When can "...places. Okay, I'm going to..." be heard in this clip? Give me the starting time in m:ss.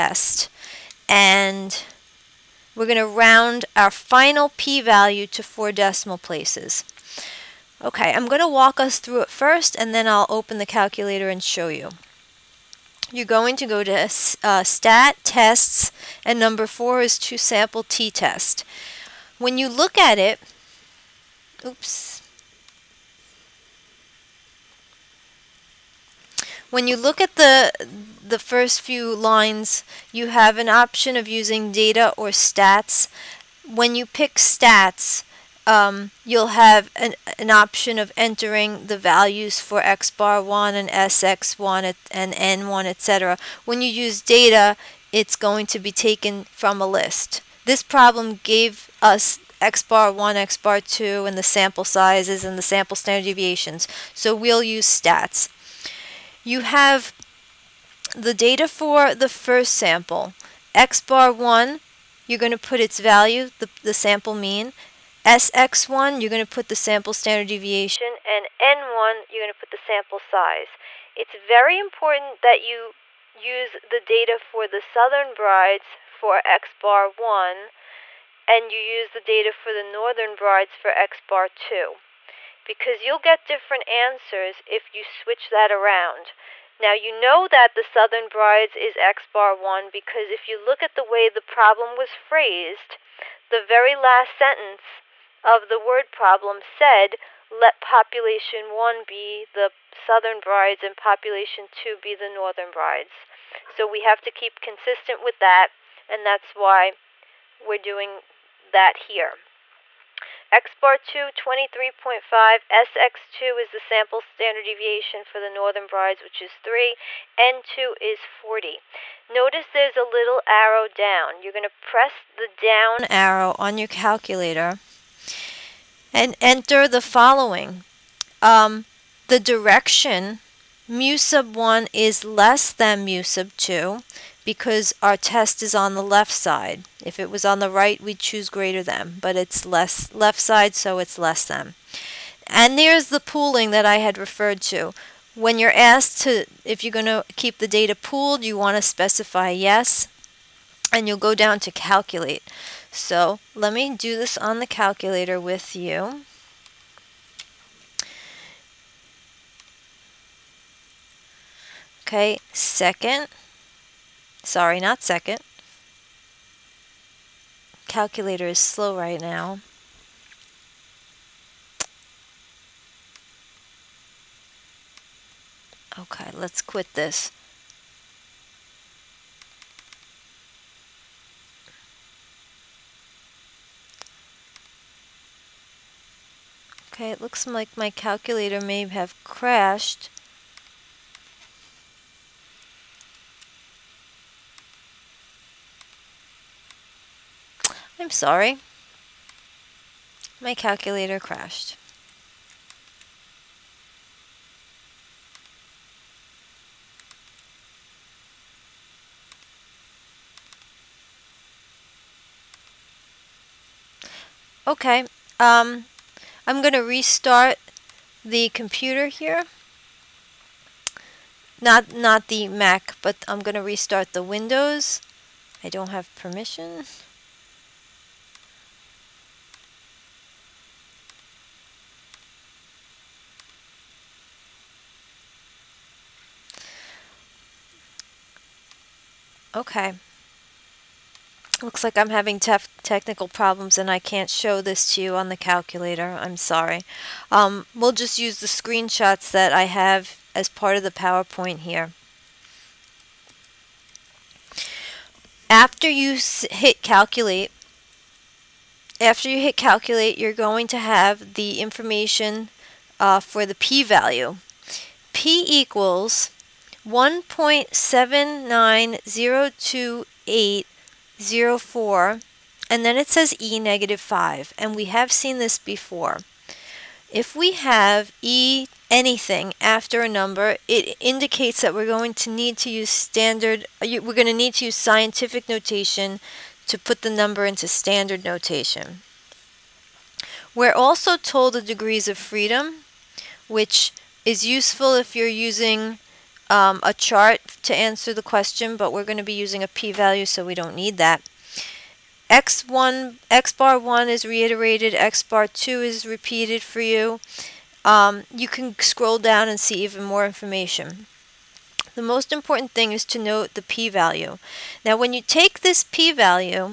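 0:06.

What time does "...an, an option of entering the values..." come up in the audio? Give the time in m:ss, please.
0:36.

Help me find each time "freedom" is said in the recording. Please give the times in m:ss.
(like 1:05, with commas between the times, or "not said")
4:52.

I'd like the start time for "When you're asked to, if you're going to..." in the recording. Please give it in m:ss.
2:25.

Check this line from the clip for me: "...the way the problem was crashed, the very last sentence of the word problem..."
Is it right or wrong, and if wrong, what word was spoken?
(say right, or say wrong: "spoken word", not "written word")
wrong: "phrased", not "crashed".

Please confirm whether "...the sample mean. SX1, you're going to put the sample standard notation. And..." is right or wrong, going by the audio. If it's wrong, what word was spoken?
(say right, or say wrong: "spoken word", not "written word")
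wrong: "deviation", not "notation".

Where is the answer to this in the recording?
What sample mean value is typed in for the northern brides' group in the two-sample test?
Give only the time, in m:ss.
1:51.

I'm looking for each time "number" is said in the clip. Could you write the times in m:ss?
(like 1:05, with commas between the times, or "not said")
0:16, 4:40, 4:47.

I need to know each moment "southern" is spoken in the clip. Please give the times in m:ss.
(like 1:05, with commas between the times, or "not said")
1:14, 1:27, 1:39.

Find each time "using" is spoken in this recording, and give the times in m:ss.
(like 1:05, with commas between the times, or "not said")
0:31, 4:55, 4:59.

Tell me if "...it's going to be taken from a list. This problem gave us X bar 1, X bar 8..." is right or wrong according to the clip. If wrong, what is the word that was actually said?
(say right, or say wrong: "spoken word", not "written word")
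wrong: "2", not "8".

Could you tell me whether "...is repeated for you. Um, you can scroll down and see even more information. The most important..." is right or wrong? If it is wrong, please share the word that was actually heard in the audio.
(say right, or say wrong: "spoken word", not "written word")
right.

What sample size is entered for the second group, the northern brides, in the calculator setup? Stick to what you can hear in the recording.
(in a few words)
40.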